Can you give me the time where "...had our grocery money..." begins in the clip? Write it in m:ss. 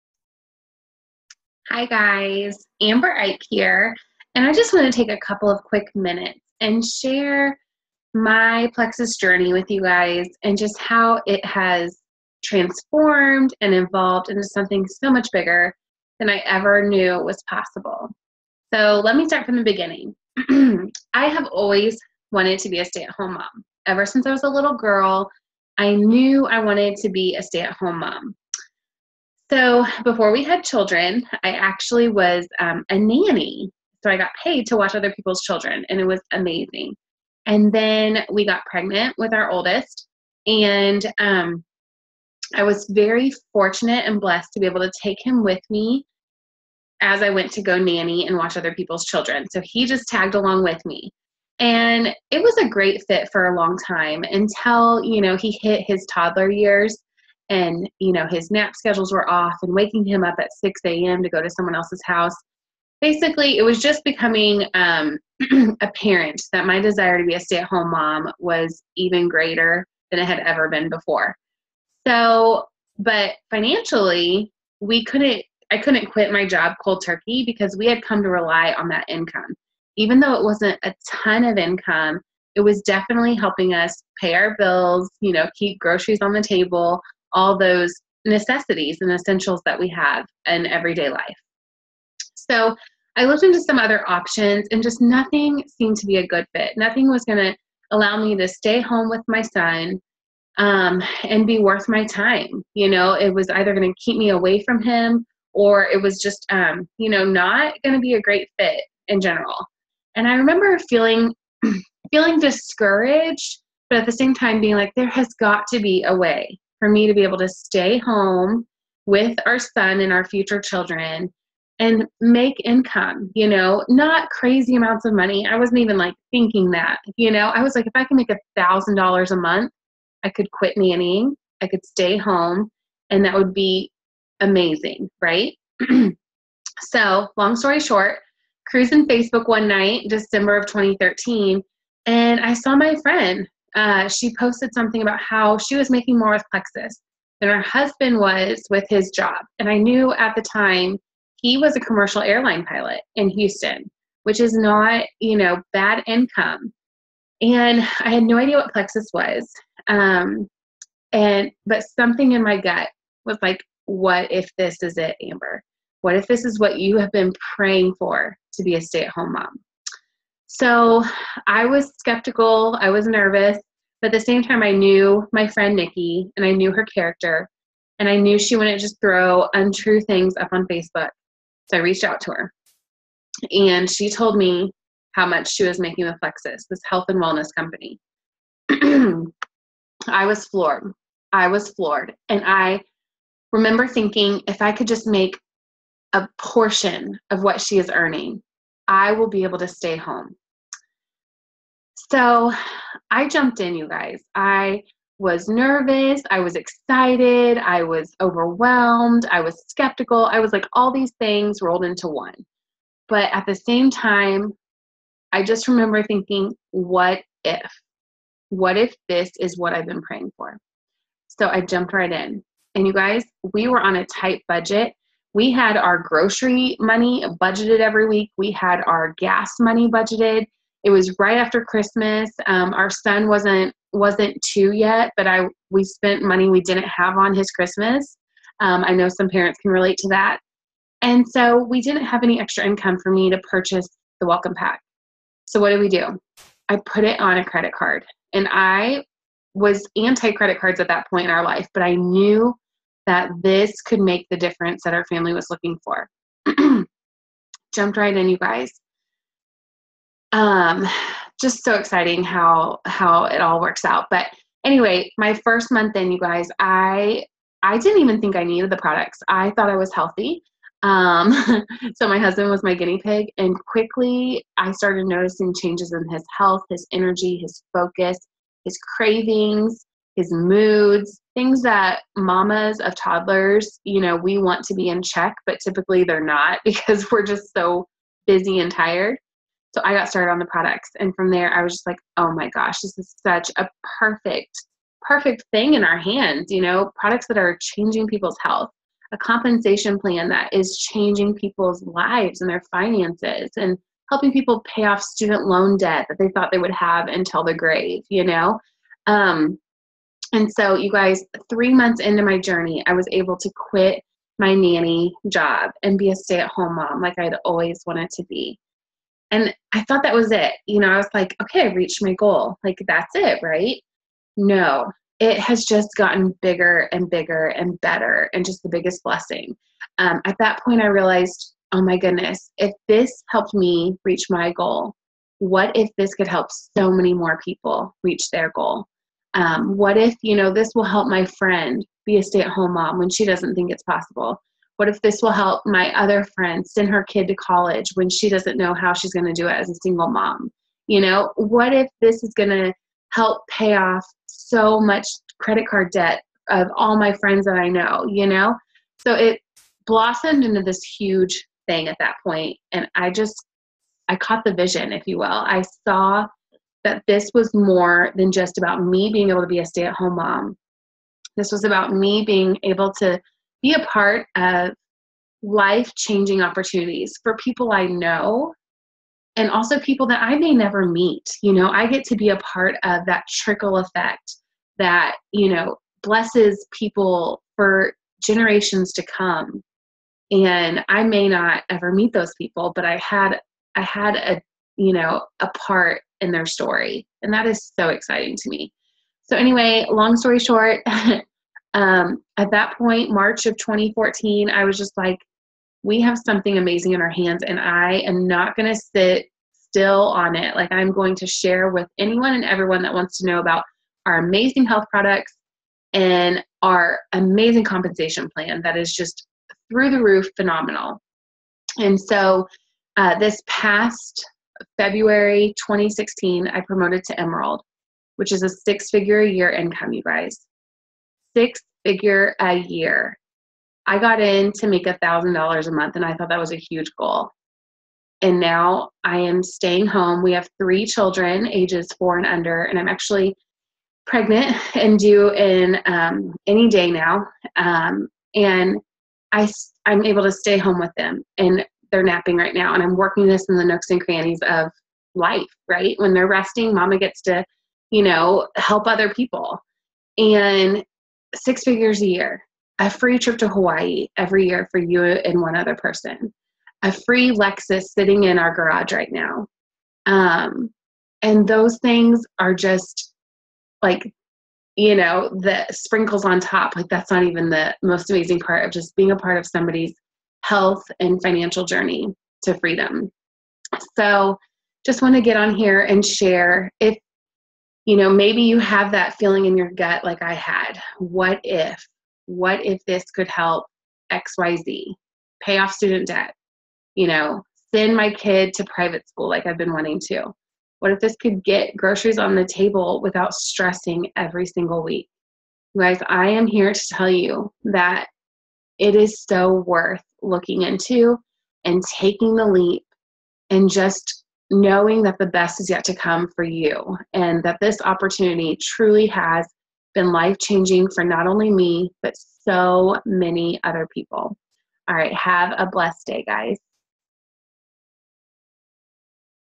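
3:45.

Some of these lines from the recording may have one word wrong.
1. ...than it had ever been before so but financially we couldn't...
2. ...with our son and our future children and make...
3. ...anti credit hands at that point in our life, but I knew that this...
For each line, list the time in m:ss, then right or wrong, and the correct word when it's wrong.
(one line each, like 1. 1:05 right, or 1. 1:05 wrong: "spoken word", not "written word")
1. 1:10 right
2. 1:59 right
3. 4:09 wrong: "cards", not "hands".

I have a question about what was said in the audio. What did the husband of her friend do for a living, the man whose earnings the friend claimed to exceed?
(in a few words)
commercial airline pilot.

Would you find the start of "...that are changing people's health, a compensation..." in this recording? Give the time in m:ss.
4:57.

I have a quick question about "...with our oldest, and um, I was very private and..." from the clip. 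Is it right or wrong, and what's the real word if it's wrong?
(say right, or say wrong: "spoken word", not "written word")
wrong: "fortunate", not "private".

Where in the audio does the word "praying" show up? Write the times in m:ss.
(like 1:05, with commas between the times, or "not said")
2:47, 3:40.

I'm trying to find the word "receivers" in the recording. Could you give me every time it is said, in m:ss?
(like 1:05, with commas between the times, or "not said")
not said.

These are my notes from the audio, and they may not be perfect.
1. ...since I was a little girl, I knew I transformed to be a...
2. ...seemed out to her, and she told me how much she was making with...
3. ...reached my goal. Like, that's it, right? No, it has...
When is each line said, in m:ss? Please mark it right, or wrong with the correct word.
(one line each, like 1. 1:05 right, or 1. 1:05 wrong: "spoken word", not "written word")
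1. 0:24 wrong: "wanted", not "transformed"
2. 3:01 wrong: "reached", not "seemed"
3. 5:21 right.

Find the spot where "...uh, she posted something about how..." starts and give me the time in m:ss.
2:23.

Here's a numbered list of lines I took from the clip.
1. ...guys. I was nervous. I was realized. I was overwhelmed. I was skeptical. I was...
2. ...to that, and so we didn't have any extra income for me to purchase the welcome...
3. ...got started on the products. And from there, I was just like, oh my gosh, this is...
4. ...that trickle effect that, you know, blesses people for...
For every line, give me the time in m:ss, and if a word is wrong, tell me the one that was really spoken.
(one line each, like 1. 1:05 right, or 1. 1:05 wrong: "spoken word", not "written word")
1. 3:23 wrong: "excited", not "realized"
2. 3:59 right
3. 4:49 right
4. 6:23 right.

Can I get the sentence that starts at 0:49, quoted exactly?
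So he just tagged along with me.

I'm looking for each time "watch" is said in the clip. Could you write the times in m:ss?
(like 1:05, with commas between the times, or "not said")
0:34, 0:48.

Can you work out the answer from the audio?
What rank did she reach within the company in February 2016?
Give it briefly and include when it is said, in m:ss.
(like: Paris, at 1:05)
Emerald, at 7:07.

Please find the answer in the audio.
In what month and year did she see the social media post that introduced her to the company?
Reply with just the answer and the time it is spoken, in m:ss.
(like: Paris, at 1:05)
December 2013, at 2:20.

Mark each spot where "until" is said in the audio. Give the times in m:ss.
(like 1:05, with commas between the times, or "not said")
0:54, 5:07.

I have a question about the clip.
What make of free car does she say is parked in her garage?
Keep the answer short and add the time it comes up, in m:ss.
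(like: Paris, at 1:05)
Lexus, at 7:47.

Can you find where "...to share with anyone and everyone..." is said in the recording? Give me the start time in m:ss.
6:51.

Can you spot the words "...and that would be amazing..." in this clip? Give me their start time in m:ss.
2:13.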